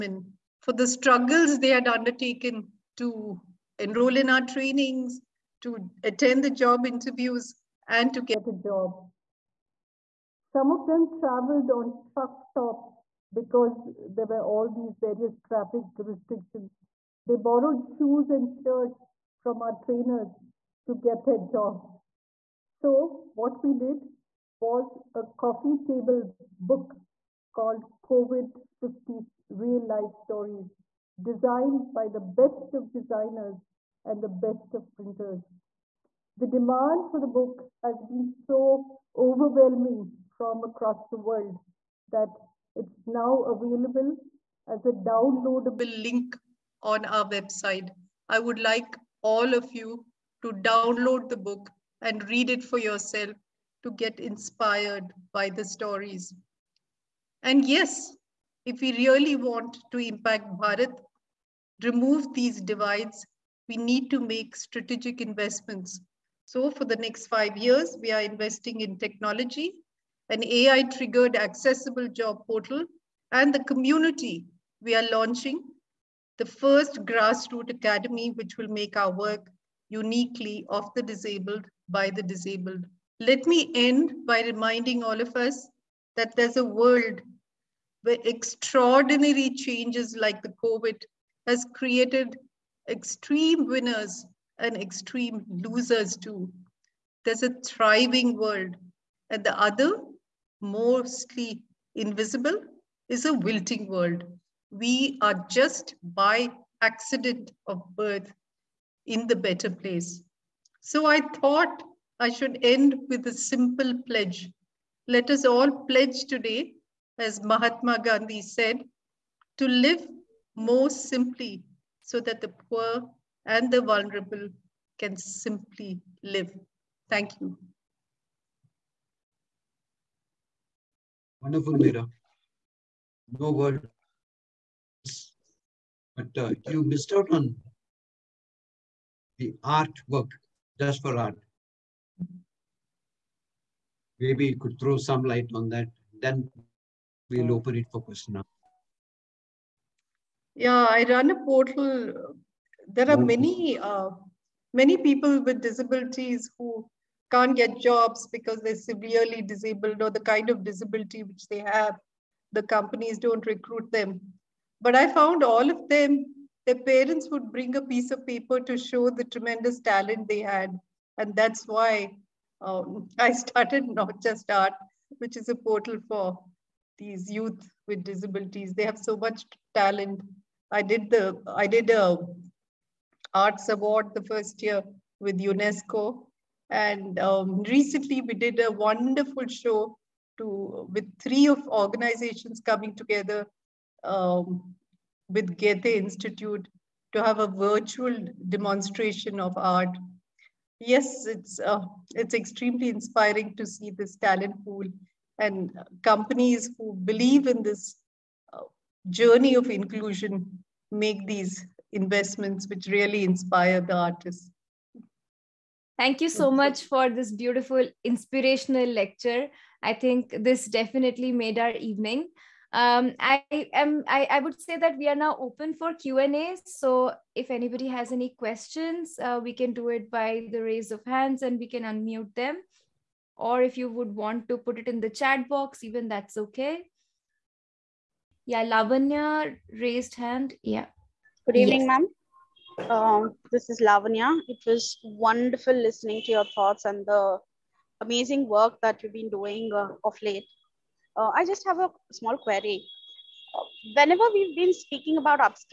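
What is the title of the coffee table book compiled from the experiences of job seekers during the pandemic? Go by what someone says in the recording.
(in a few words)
COVID 50 Real Life Stories.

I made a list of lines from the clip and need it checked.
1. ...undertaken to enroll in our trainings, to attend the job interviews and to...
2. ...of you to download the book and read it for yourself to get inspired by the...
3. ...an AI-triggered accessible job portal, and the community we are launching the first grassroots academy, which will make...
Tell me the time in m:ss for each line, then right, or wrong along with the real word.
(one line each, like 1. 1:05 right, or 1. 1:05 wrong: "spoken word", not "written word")
1. 0:01 right
2. 0:49 right
3. 1:10 right.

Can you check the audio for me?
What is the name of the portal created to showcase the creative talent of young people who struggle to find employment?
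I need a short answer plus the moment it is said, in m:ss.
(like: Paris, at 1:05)
Not Just Art, at 2:53.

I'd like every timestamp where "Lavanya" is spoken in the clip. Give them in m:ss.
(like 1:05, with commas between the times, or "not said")
3:58, 4:03.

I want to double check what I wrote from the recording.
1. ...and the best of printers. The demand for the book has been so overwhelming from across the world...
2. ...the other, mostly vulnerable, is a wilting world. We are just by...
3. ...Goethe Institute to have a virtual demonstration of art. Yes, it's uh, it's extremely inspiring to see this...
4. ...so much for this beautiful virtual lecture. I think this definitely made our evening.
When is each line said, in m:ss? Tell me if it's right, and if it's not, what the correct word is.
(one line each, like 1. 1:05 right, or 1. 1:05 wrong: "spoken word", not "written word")
1. 0:34 right
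2. 1:39 wrong: "invisible", not "vulnerable"
3. 3:15 right
4. 3:36 wrong: "inspirational", not "virtual".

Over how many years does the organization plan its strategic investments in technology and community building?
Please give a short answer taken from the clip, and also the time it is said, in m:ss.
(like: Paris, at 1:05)
5, at 1:07.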